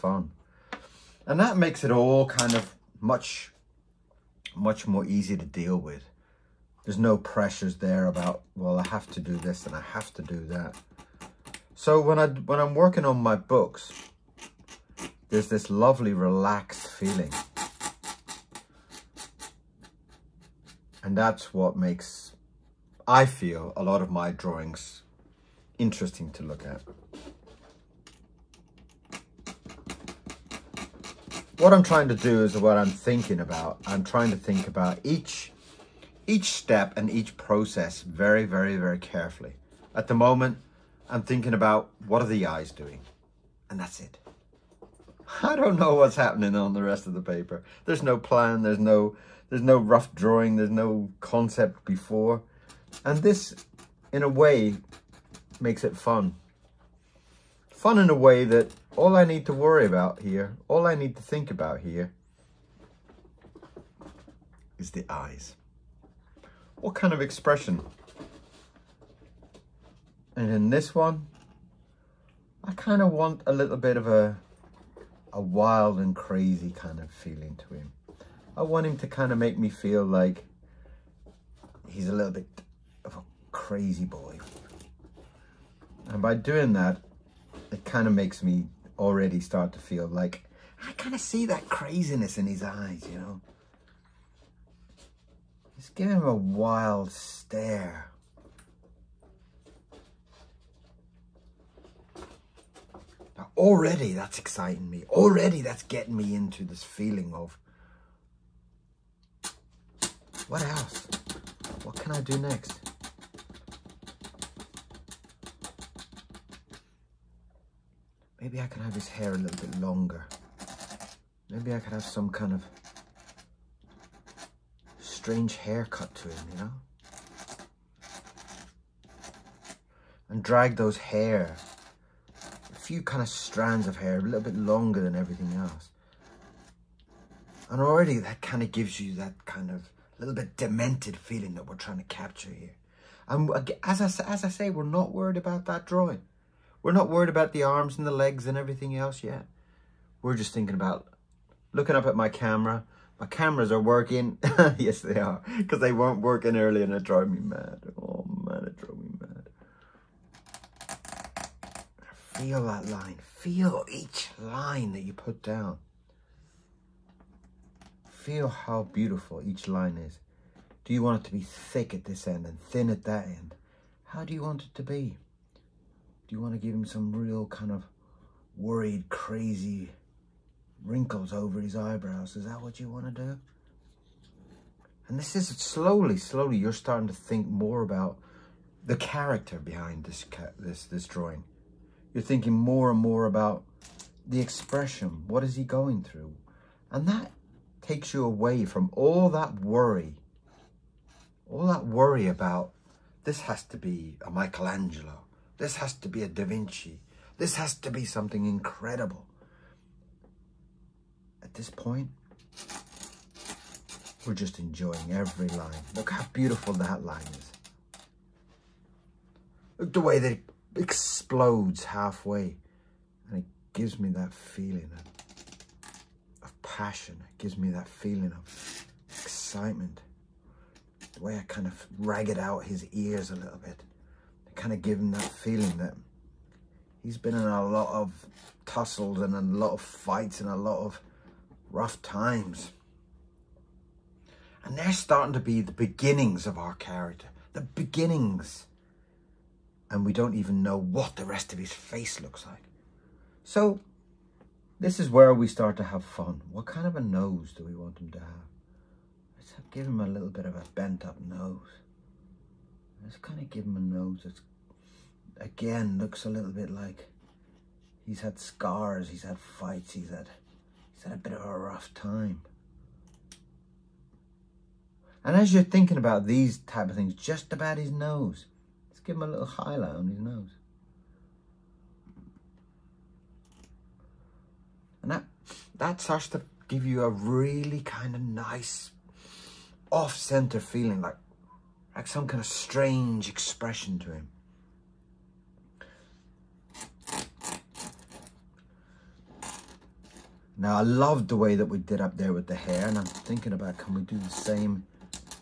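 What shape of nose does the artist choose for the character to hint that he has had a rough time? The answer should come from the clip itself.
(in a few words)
Bent up nose.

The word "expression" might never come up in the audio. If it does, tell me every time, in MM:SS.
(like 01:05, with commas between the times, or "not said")
01:07, 03:14, 04:53.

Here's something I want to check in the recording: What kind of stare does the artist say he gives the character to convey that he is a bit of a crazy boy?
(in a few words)
A wild stare.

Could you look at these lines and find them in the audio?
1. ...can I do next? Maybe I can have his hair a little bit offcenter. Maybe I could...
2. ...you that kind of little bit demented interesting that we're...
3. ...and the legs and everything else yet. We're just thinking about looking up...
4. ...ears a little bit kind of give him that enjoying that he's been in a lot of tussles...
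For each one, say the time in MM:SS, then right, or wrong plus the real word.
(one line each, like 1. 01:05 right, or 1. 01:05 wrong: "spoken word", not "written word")
1. 01:51 wrong: "longer", not "offcenter"
2. 02:19 wrong: "feeling", not "interesting"
3. 02:27 right
4. 03:52 wrong: "feeling", not "enjoying".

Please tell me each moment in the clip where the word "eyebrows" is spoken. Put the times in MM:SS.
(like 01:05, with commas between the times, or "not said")
03:01.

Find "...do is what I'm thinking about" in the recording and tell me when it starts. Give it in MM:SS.
00:32.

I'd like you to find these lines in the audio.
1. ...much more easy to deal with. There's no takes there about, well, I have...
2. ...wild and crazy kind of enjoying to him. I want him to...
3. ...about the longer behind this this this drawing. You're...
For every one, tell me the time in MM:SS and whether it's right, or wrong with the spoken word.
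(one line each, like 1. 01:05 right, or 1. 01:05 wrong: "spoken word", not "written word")
1. 00:04 wrong: "pressures", not "takes"
2. 01:15 wrong: "feeling", not "enjoying"
3. 03:07 wrong: "character", not "longer".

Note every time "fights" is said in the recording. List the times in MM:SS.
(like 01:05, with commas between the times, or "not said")
03:59, 04:29.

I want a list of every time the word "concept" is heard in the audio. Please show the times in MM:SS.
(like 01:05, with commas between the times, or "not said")
00:51.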